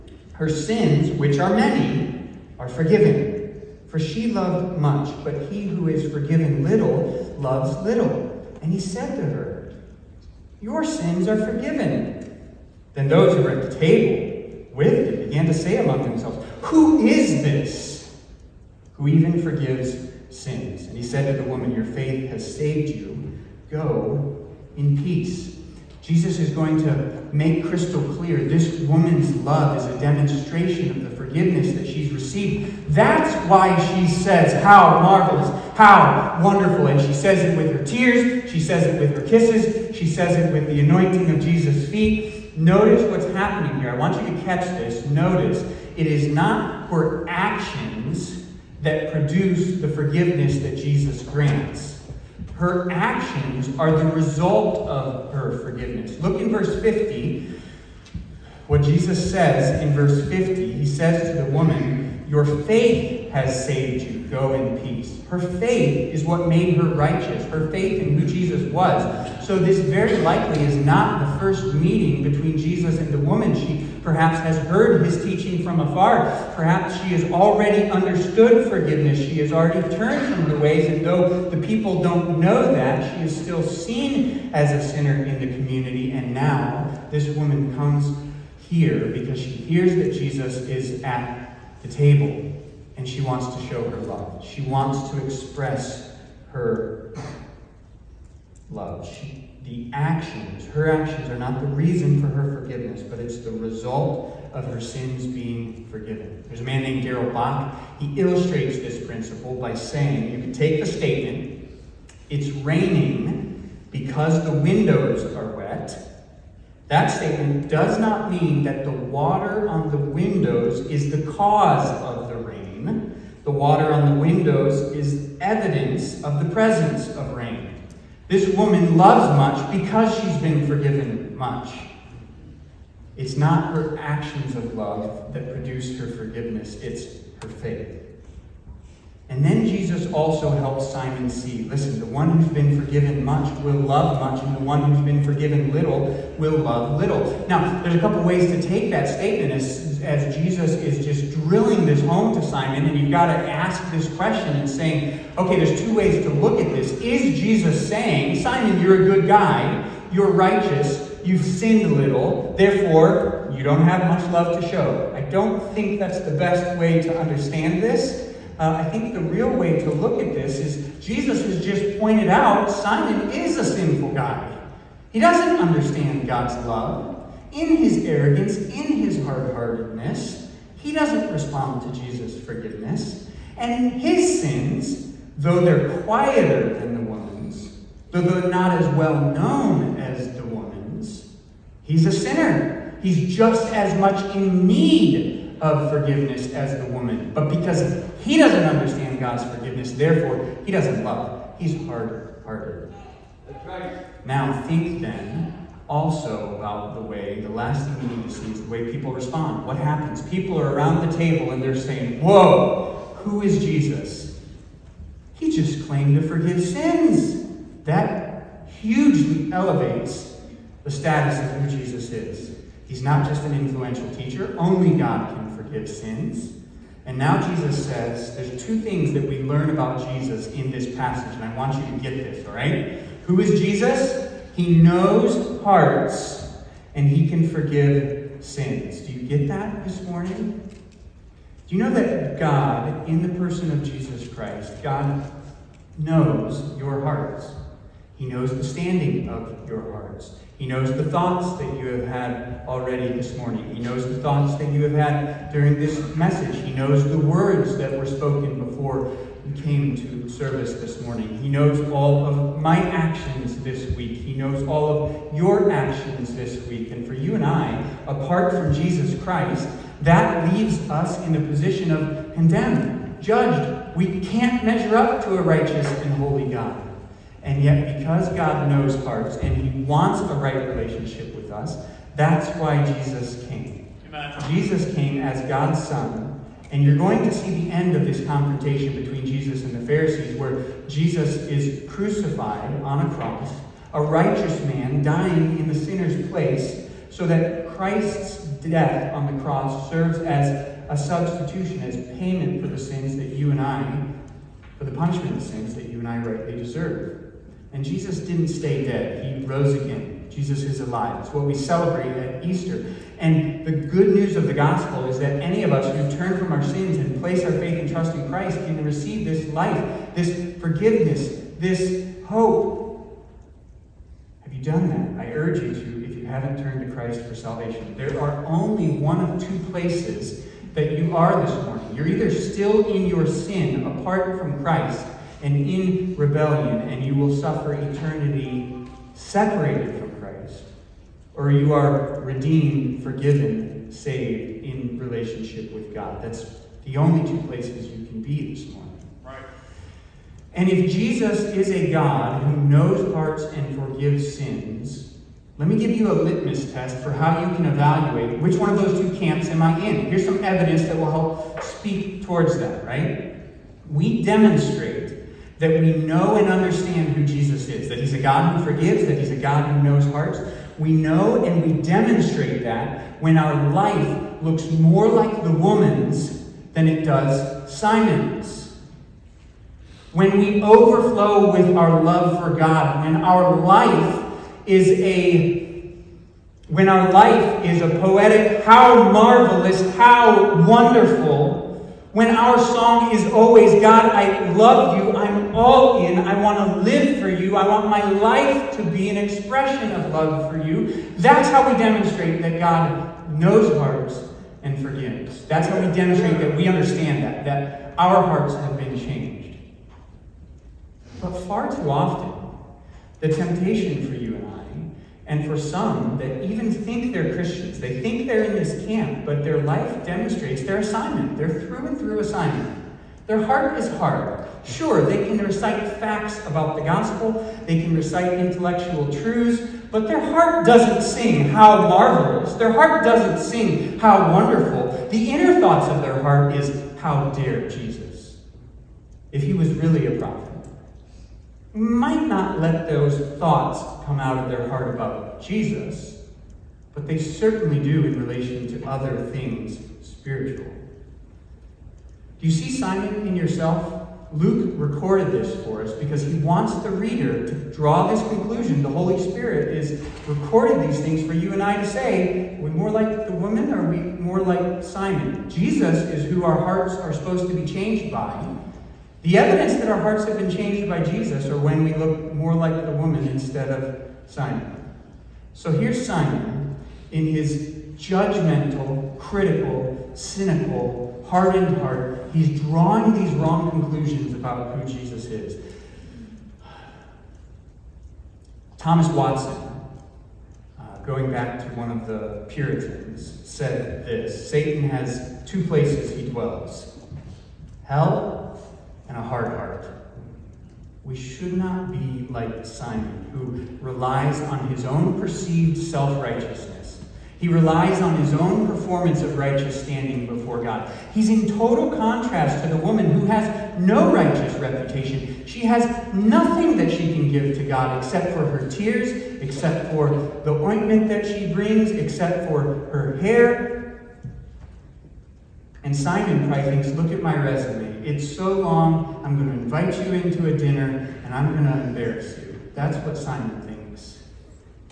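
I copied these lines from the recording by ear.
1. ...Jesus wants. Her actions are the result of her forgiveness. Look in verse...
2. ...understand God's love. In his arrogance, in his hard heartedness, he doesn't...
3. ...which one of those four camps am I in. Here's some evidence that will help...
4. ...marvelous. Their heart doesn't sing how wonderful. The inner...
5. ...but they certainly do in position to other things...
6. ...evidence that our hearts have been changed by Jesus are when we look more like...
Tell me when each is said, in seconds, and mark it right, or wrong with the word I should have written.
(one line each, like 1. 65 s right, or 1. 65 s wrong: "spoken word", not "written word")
1. 50 s wrong: "grants", not "wants"
2. 175 s right
3. 358 s wrong: "two", not "four"
4. 431 s right
5. 446 s wrong: "relation", not "position"
6. 469 s right.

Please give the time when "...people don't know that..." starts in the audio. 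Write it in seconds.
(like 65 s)
81 s.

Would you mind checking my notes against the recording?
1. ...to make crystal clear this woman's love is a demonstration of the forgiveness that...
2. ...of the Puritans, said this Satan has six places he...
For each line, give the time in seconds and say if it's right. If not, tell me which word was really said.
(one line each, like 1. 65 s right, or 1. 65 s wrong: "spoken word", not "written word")
1. 26 s right
2. 491 s wrong: "two", not "six".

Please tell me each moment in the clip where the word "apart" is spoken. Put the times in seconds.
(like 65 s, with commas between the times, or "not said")
268 s, 333 s.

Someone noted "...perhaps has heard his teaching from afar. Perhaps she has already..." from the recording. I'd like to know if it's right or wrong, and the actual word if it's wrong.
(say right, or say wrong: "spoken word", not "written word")
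right.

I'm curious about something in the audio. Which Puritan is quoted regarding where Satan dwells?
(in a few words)
Thomas Watson.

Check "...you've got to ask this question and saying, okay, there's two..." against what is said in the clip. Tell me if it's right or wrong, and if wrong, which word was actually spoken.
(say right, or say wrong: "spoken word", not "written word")
right.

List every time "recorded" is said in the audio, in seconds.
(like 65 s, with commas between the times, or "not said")
454 s, 460 s.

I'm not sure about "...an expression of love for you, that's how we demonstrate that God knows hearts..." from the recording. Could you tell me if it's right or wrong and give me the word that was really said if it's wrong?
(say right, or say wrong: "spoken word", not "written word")
right.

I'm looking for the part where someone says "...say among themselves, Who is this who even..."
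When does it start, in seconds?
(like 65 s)
15 s.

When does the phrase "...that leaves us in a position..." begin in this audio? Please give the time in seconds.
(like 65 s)
270 s.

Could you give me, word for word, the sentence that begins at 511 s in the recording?
He's in total contrast to the woman who has no righteous reputation.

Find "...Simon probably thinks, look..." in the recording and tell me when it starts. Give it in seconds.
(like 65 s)
525 s.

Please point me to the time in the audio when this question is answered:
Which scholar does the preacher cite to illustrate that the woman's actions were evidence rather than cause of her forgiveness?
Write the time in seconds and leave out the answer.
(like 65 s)
107 s.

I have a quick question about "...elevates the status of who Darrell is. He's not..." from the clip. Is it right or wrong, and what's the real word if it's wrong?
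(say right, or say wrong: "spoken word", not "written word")
wrong: "Jesus", not "Darrell".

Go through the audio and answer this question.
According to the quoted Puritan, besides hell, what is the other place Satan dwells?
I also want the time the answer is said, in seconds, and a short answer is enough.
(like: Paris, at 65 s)
a hard heart, at 499 s.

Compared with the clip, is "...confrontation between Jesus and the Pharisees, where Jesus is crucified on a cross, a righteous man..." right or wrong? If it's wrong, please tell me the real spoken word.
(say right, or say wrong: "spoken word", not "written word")
right.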